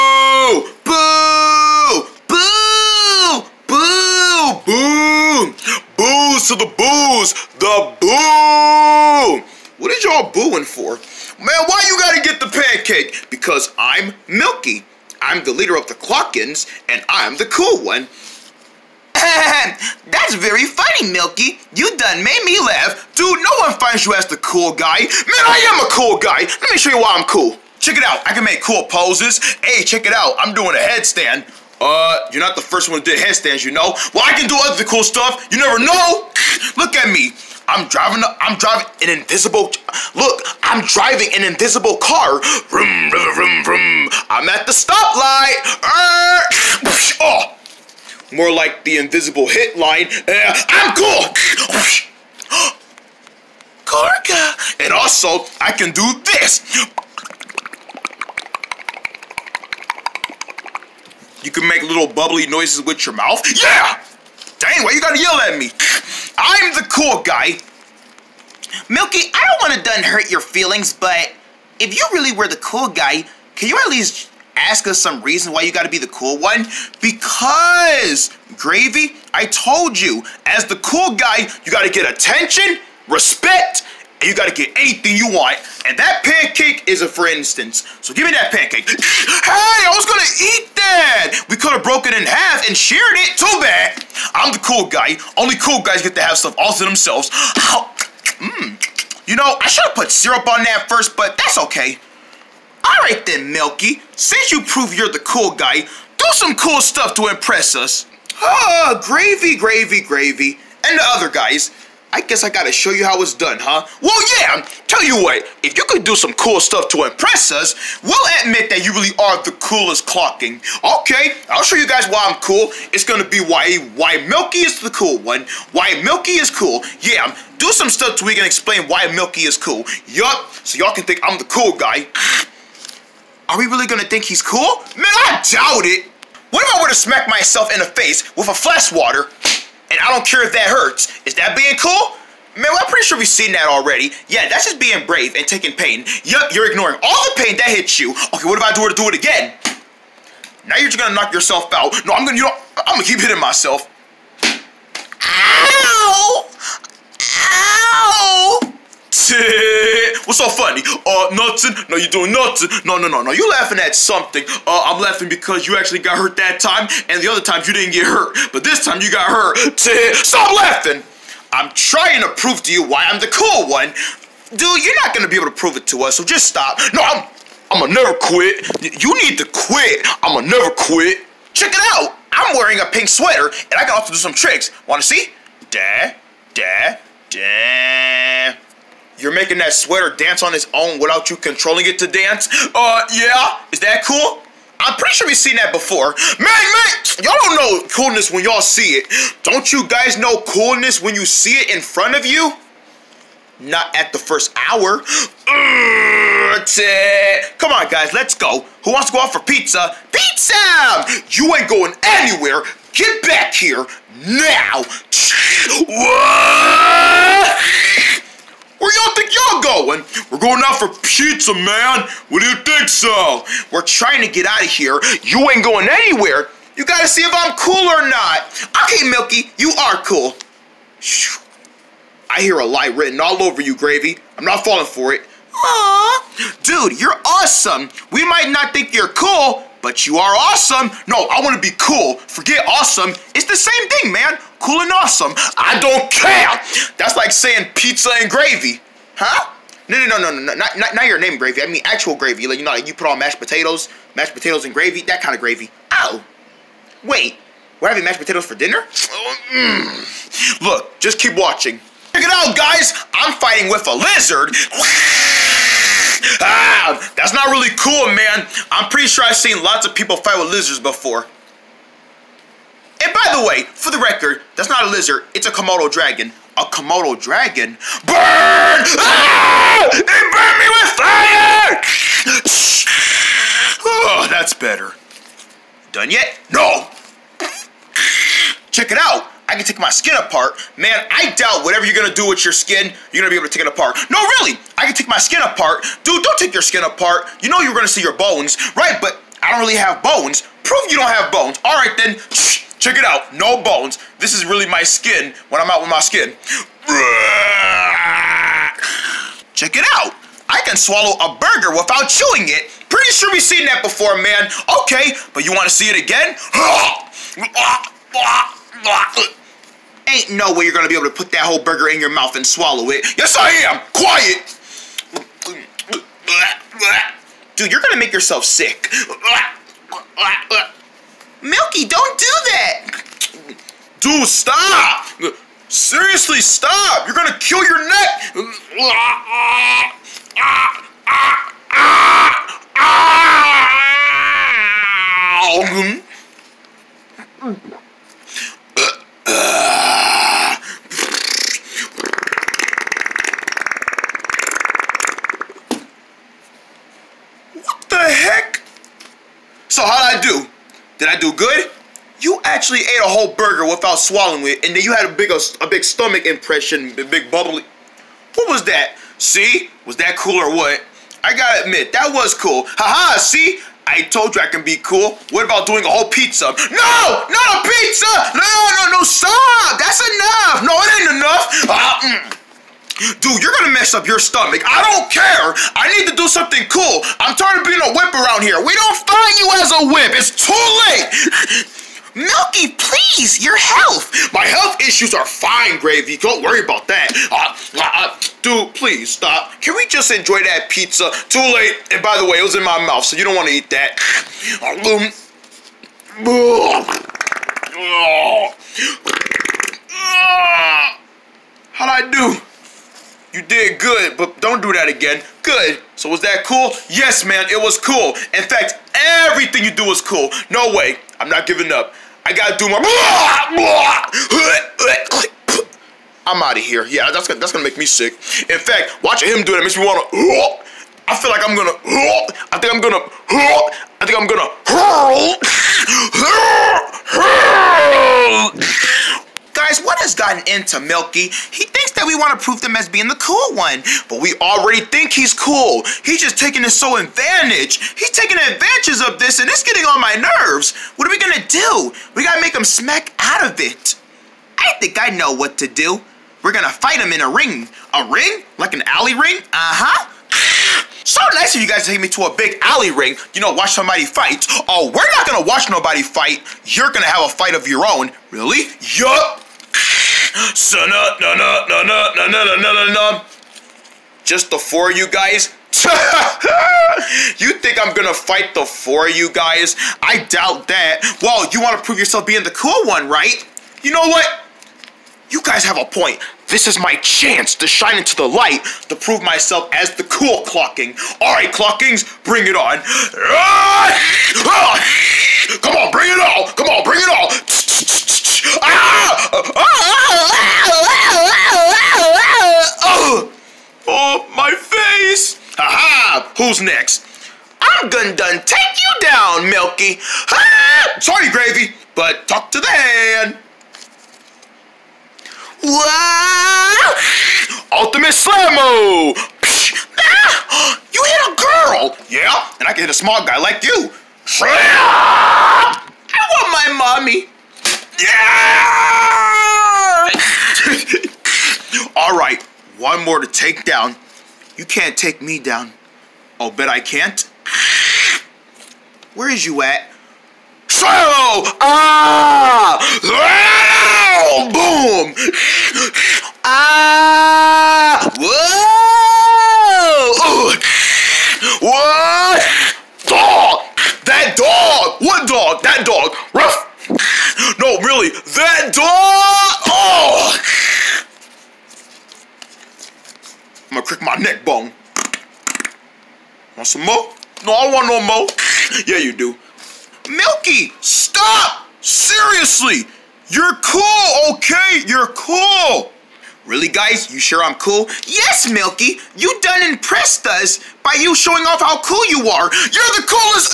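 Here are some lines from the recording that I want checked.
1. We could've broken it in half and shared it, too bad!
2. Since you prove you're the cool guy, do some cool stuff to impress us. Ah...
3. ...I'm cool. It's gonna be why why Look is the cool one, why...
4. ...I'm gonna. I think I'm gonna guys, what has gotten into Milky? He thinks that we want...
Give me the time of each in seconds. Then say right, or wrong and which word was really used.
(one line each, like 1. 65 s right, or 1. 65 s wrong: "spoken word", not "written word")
1. 91 s right
2. 104 s right
3. 122 s wrong: "Milky", not "Look"
4. 432 s right.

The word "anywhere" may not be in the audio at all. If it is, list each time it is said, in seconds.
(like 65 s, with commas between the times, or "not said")
212 s, 225 s.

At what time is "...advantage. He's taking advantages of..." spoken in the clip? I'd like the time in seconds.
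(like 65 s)
446 s.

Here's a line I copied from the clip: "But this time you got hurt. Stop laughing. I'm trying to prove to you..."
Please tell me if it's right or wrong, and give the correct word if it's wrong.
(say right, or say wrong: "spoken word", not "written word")
right.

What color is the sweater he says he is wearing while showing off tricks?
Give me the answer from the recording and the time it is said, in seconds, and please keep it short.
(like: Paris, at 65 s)
Pink, at 182 s.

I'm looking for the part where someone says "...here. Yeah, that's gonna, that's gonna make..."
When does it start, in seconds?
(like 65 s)
426 s.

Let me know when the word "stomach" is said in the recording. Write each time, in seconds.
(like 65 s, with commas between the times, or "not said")
365 s, 384 s.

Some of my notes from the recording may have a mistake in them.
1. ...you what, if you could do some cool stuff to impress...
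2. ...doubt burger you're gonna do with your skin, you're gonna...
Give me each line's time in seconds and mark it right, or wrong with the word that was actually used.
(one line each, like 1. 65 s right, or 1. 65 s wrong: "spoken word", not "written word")
1. 115 s right
2. 291 s wrong: "whatever", not "burger".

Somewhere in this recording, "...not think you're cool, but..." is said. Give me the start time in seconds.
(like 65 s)
238 s.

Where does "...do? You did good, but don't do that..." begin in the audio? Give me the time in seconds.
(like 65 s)
412 s.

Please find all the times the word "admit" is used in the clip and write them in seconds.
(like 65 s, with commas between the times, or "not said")
118 s, 371 s.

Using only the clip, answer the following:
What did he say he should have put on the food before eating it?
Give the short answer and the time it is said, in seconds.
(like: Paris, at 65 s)
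Syrup, at 100 s.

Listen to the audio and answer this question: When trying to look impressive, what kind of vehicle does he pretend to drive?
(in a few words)
An invisible car.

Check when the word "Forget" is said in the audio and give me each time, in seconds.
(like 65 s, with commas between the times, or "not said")
242 s.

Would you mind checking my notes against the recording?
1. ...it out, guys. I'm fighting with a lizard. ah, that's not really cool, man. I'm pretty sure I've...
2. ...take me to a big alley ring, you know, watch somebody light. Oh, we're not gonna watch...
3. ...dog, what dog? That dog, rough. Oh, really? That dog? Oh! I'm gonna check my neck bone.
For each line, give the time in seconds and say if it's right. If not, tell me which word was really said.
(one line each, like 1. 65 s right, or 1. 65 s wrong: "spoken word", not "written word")
1. 262 s right
2. 461 s wrong: "fight", not "light"
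3. 554 s wrong: "crick", not "check".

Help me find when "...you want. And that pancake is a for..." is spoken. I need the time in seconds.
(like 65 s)
85 s.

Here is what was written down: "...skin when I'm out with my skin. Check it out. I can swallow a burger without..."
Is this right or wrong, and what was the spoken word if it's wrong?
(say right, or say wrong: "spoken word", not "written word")
right.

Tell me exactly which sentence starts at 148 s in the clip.
Okay, what if I do it to do it again?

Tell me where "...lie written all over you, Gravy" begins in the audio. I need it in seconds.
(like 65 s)
232 s.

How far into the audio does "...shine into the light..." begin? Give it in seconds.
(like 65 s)
487 s.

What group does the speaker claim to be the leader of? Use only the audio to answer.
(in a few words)
The Clockins.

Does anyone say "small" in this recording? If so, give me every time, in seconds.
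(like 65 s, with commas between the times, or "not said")
522 s.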